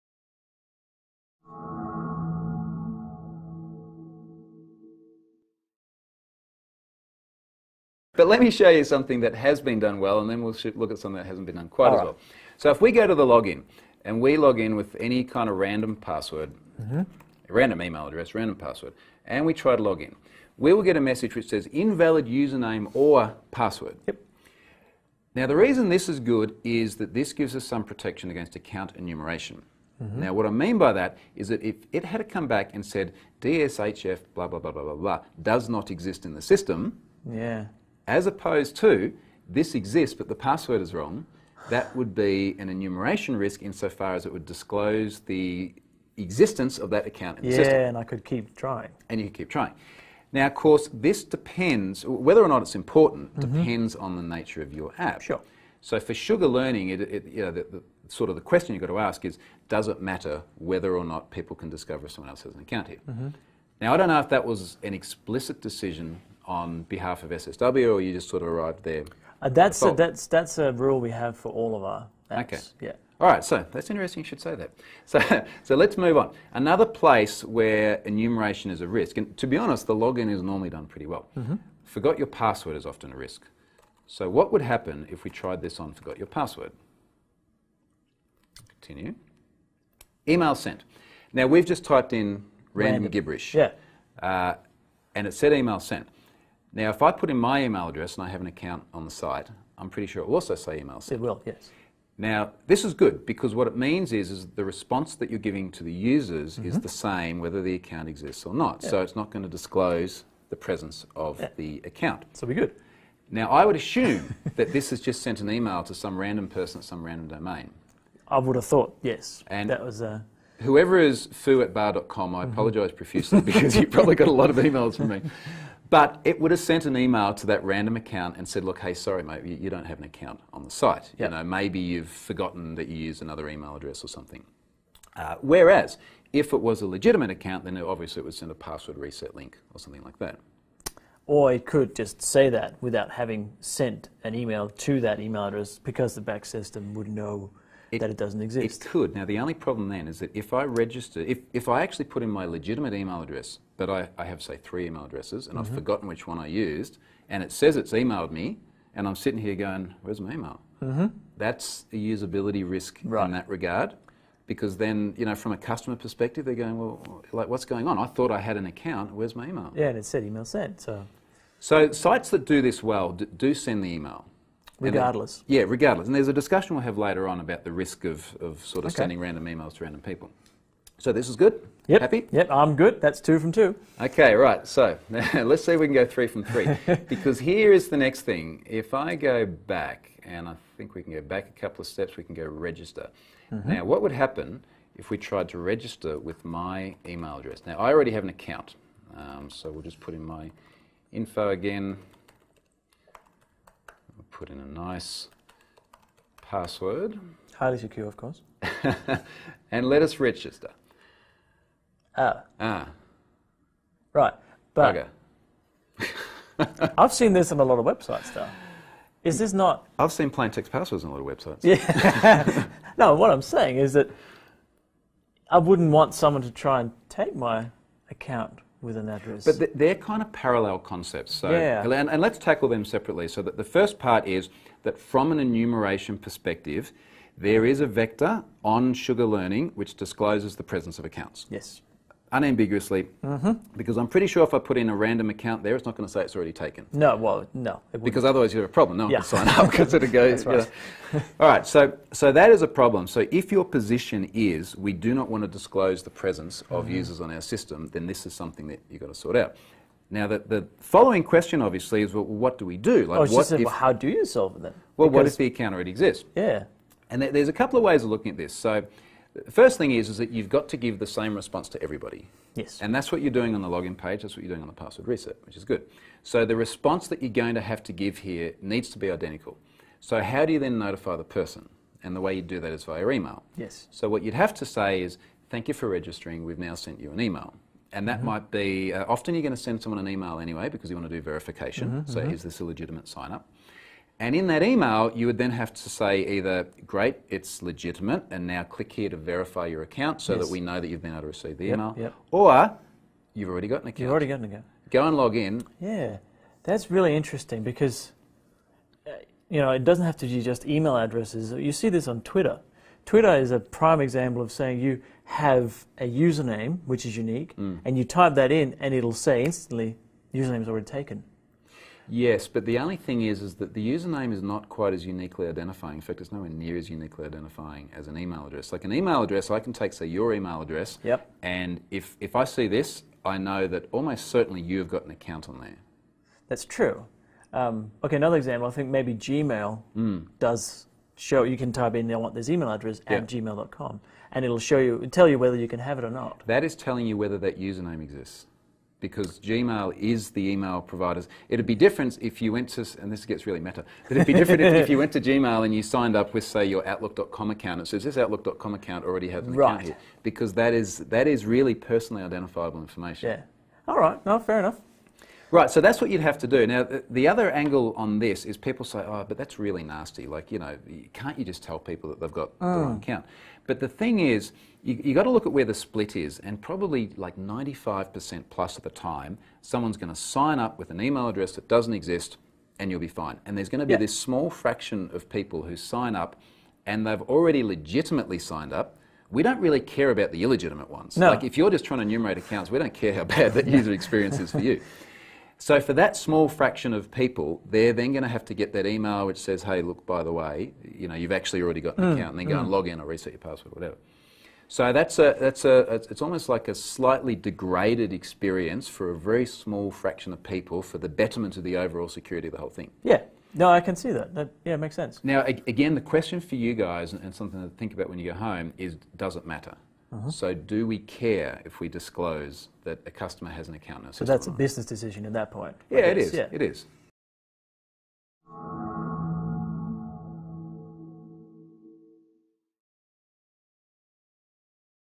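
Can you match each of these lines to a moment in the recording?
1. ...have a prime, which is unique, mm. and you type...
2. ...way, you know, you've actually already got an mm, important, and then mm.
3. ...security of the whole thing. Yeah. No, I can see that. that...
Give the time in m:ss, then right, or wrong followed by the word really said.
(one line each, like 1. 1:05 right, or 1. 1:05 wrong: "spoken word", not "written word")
1. 5:15 wrong: "username", not "prime"
2. 6:40 wrong: "account", not "important"
3. 6:52 right.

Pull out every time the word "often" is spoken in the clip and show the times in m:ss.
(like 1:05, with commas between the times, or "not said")
1:22, 4:49.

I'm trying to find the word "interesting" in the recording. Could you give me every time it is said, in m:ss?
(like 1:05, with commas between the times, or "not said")
1:13, 5:07.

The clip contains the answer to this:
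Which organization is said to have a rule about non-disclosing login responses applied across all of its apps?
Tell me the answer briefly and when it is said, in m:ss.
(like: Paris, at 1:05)
SSW, at 1:07.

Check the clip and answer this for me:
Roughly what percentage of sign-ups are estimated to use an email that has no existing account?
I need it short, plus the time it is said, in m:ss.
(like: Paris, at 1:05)
95%, at 6:17.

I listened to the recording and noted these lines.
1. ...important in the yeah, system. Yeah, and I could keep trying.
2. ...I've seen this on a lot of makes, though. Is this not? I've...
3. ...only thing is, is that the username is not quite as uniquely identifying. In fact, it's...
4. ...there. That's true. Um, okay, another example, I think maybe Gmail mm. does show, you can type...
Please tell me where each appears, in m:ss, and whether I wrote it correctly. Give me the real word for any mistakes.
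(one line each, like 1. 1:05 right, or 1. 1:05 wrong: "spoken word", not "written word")
1. 0:47 wrong: "account", not "important"
2. 3:36 wrong: "websites", not "makes"
3. 5:22 right
4. 5:35 right.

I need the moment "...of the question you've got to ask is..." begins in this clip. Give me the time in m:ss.
0:58.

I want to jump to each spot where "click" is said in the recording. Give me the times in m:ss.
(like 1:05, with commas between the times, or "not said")
4:58.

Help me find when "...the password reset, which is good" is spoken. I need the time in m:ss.
4:34.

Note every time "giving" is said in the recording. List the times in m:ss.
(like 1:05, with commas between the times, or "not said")
1:45.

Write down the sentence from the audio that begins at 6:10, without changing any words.
Like, you know, can't you just tell people that they've got the mm.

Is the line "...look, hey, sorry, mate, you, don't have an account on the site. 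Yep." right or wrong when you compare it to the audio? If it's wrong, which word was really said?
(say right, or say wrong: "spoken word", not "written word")
right.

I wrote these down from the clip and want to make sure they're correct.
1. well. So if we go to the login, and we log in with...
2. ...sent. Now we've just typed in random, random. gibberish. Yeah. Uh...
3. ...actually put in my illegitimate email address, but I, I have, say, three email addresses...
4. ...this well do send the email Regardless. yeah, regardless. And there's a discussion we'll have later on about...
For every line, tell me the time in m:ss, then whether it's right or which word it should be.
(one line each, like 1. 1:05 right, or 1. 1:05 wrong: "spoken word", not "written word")
1. 0:12 right
2. 1:30 right
3. 2:31 wrong: "legitimate", not "illegitimate"
4. 2:52 right.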